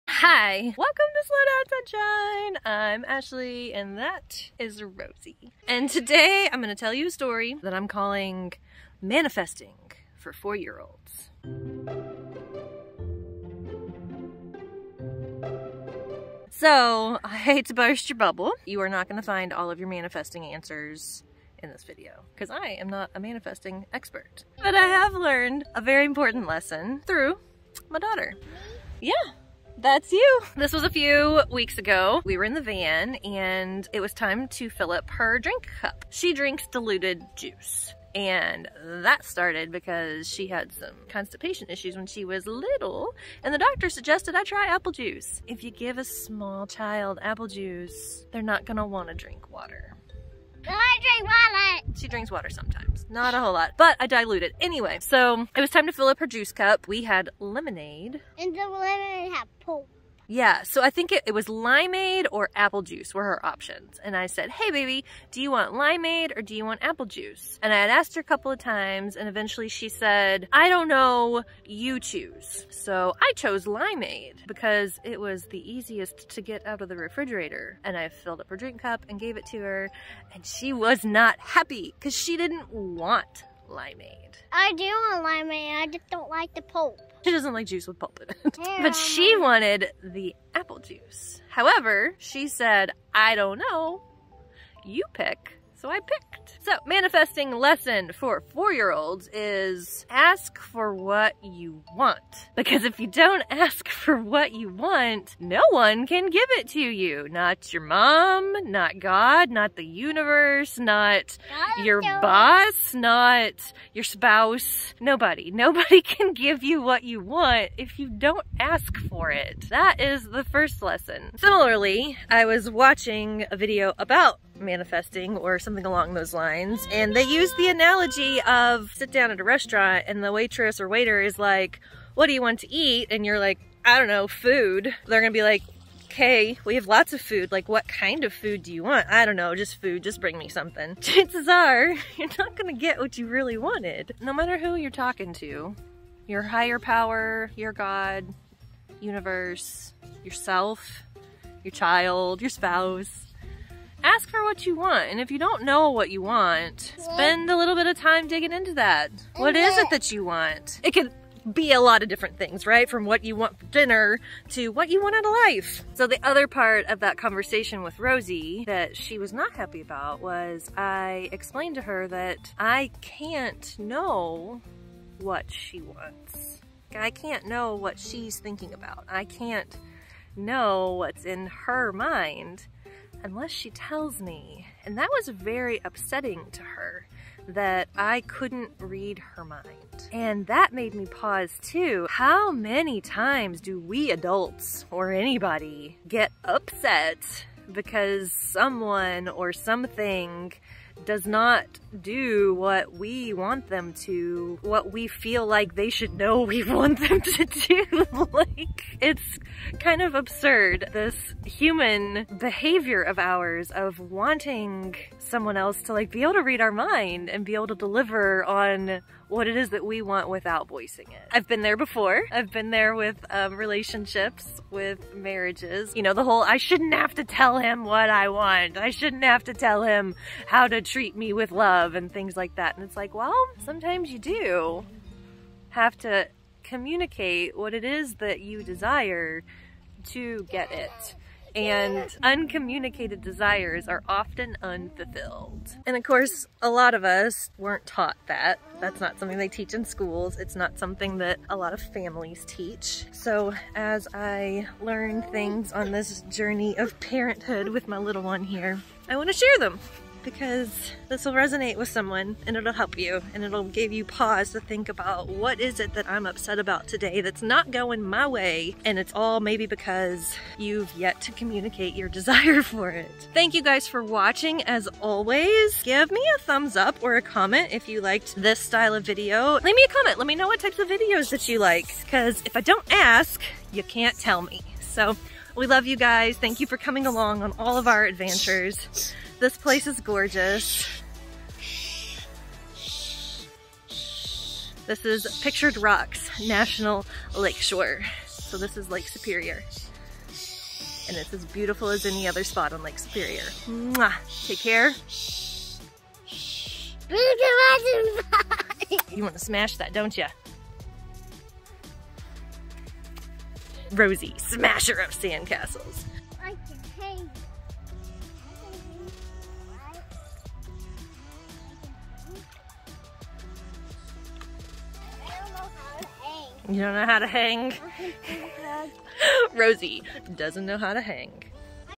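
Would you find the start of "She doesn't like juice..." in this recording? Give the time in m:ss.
1:27.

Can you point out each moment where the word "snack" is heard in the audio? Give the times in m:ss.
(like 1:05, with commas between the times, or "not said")
not said.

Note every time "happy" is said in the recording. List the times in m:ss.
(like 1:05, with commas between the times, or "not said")
1:21, 2:49.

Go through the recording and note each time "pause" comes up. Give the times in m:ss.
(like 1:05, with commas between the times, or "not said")
3:11, 4:24.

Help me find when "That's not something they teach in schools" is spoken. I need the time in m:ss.
4:08.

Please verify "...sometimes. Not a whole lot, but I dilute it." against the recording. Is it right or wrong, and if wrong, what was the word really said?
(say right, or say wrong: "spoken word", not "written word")
right.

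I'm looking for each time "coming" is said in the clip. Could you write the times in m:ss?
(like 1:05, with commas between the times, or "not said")
4:46.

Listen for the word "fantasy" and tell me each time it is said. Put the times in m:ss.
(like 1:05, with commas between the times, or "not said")
not said.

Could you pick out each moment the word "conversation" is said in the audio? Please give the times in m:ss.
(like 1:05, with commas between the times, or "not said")
2:47.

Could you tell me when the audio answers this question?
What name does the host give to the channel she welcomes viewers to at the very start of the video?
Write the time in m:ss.
0:01.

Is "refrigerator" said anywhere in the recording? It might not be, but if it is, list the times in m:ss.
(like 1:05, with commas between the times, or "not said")
1:16.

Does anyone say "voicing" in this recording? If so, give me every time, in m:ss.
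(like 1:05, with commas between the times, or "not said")
3:40.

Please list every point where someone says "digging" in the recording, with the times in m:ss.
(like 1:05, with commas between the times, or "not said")
2:38.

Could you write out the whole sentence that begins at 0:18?
You are not going to find all of your manifesting answers in this video because I am not a manifesting expert.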